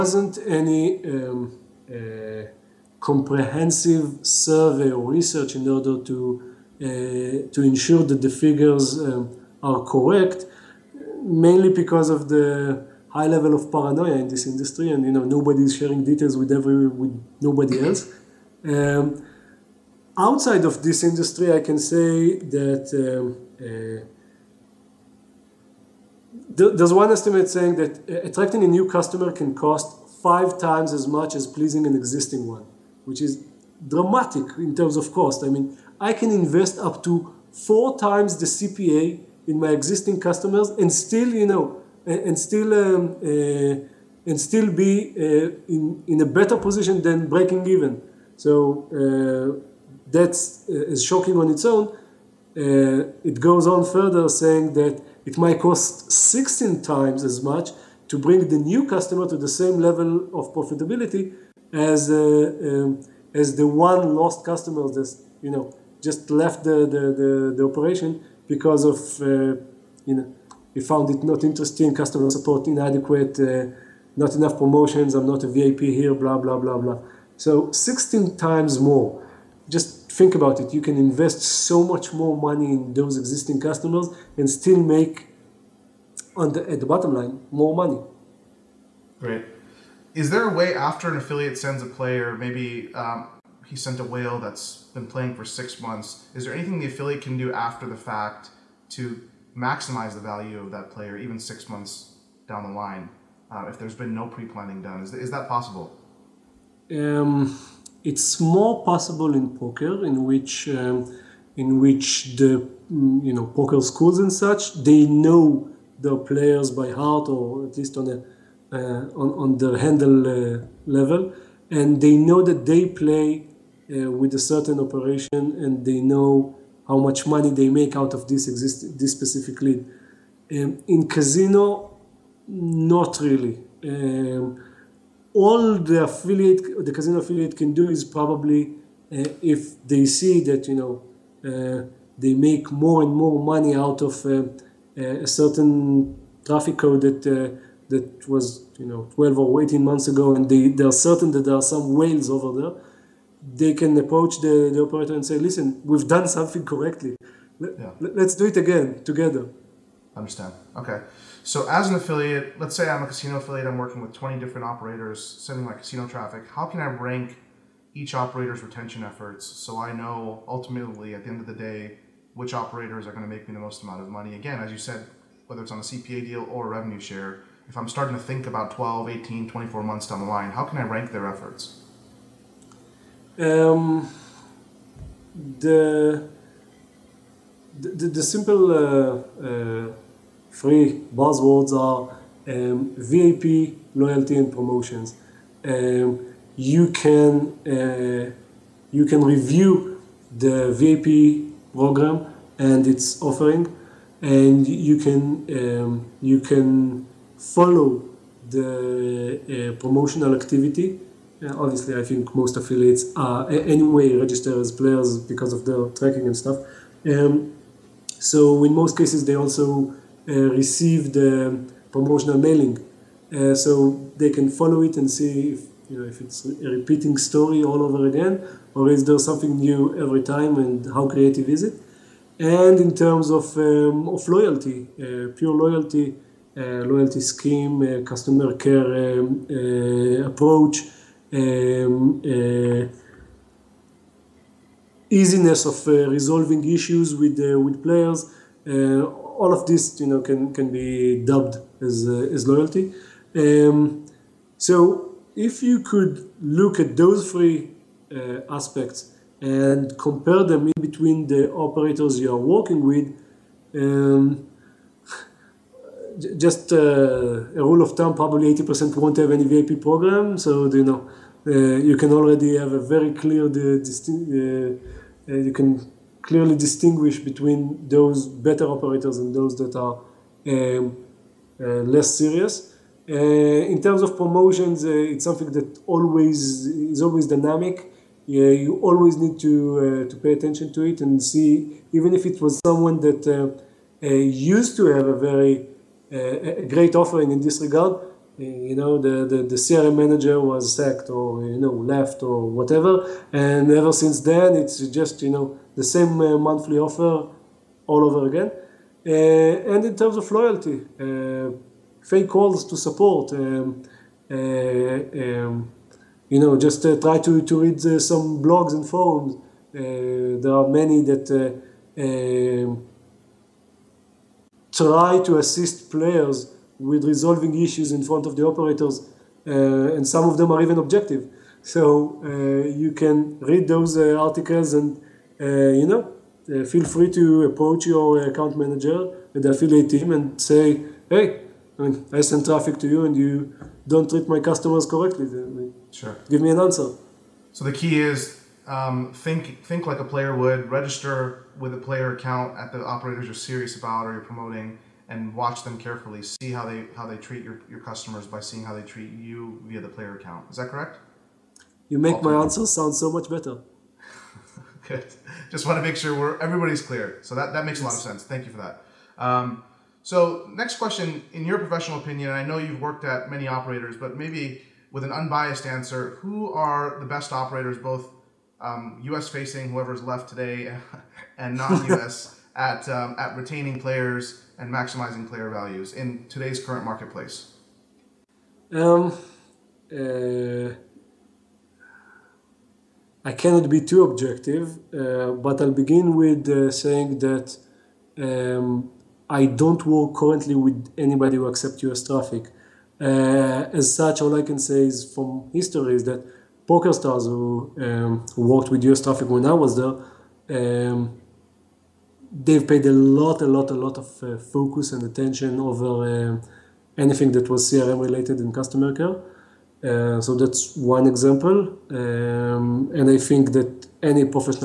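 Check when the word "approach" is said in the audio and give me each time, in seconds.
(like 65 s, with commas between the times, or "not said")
153 s, 240 s, 337 s.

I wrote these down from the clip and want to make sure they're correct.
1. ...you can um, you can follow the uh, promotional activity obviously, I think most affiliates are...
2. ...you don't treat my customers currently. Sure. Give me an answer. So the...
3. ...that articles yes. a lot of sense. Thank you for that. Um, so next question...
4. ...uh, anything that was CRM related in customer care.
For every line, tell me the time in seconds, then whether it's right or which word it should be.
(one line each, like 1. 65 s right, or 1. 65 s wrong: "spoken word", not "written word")
1. 204 s right
2. 343 s wrong: "correctly", not "currently"
3. 367 s wrong: "makes", not "articles"
4. 416 s right.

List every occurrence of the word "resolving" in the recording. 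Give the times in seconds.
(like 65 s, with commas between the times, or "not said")
246 s, 327 s.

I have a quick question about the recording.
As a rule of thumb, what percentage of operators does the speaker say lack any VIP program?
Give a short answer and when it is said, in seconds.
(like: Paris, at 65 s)
80%, at 268 s.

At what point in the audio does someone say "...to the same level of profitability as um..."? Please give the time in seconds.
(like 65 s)
59 s.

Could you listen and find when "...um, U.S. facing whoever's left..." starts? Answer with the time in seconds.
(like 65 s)
378 s.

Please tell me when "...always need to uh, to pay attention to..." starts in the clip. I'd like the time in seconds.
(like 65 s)
288 s.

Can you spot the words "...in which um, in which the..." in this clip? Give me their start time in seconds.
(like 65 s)
110 s.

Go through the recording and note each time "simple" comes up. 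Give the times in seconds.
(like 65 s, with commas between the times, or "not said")
188 s.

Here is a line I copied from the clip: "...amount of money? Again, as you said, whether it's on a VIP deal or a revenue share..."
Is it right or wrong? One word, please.
wrong.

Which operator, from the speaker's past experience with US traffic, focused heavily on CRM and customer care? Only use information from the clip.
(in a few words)
PokerStars.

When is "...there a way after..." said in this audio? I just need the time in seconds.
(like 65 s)
90 s.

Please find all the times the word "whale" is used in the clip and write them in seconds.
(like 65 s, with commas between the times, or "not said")
94 s, 151 s.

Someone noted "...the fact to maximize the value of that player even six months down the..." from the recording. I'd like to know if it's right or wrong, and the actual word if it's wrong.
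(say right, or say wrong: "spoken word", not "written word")
right.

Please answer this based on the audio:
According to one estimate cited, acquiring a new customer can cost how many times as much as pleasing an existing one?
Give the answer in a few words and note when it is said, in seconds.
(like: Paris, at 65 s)
5, at 30 s.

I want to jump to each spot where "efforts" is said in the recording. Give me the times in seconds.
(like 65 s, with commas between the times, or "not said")
169 s, 181 s.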